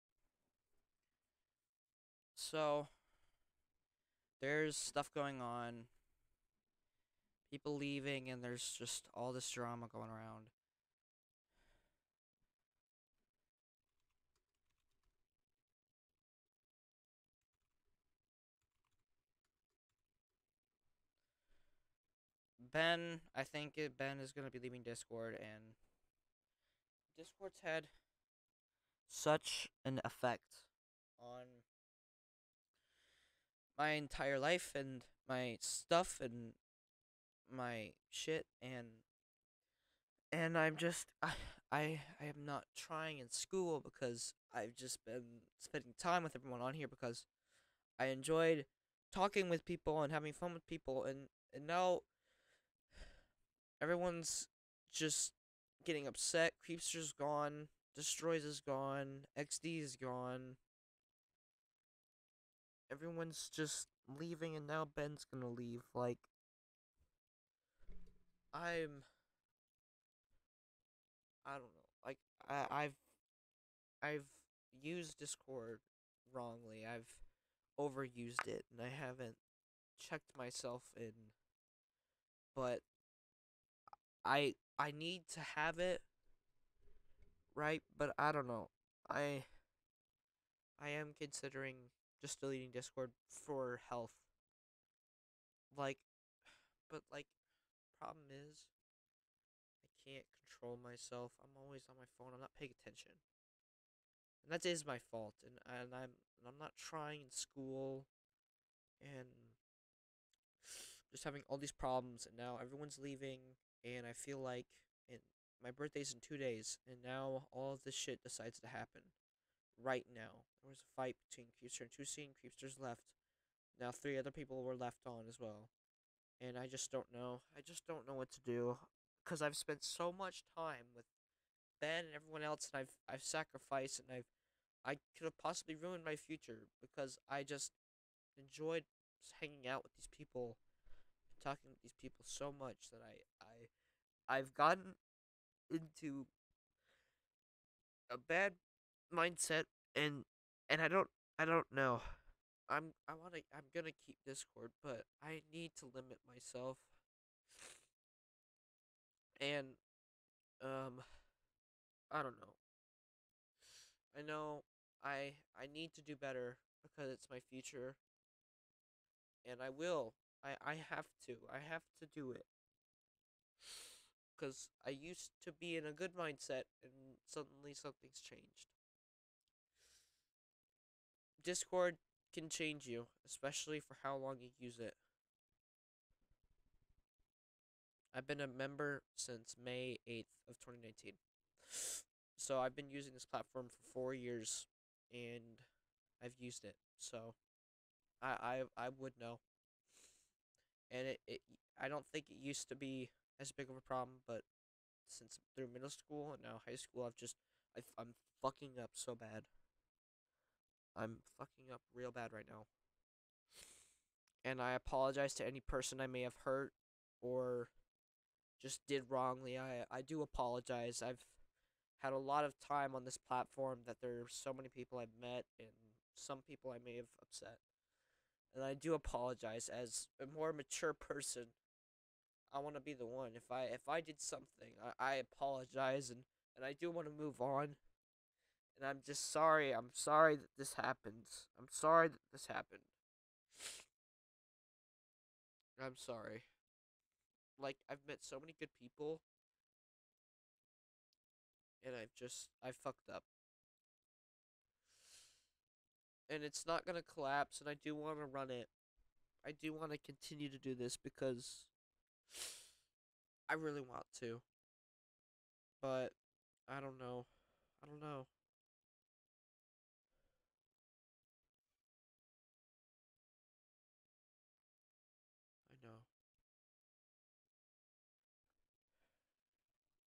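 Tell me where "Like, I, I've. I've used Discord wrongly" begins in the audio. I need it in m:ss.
1:12.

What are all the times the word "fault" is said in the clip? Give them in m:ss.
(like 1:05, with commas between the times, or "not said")
1:44.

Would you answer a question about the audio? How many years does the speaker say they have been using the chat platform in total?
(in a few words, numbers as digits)
4.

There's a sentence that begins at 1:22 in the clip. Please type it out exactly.
But I I need to have it right, but I don't know.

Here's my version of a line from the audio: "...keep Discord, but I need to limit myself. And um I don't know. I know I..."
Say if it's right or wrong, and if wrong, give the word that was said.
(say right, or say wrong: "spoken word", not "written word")
right.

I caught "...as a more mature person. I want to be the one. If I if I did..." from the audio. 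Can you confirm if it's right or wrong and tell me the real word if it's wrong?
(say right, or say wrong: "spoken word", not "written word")
right.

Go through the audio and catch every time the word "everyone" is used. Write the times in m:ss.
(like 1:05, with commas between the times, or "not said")
0:46, 0:53, 1:02, 1:52, 2:12.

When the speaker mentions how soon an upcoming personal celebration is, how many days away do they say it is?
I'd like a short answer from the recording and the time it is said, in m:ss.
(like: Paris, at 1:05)
2, at 1:56.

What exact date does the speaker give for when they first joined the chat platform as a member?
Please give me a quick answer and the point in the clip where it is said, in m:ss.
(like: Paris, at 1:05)
May 8th, 2019, at 3:09.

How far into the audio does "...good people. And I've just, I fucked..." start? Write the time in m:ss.
4:08.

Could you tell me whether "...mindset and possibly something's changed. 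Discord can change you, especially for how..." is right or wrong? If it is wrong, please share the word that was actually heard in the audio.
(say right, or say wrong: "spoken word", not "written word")
wrong: "suddenly", not "possibly".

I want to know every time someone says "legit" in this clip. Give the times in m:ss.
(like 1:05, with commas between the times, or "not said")
not said.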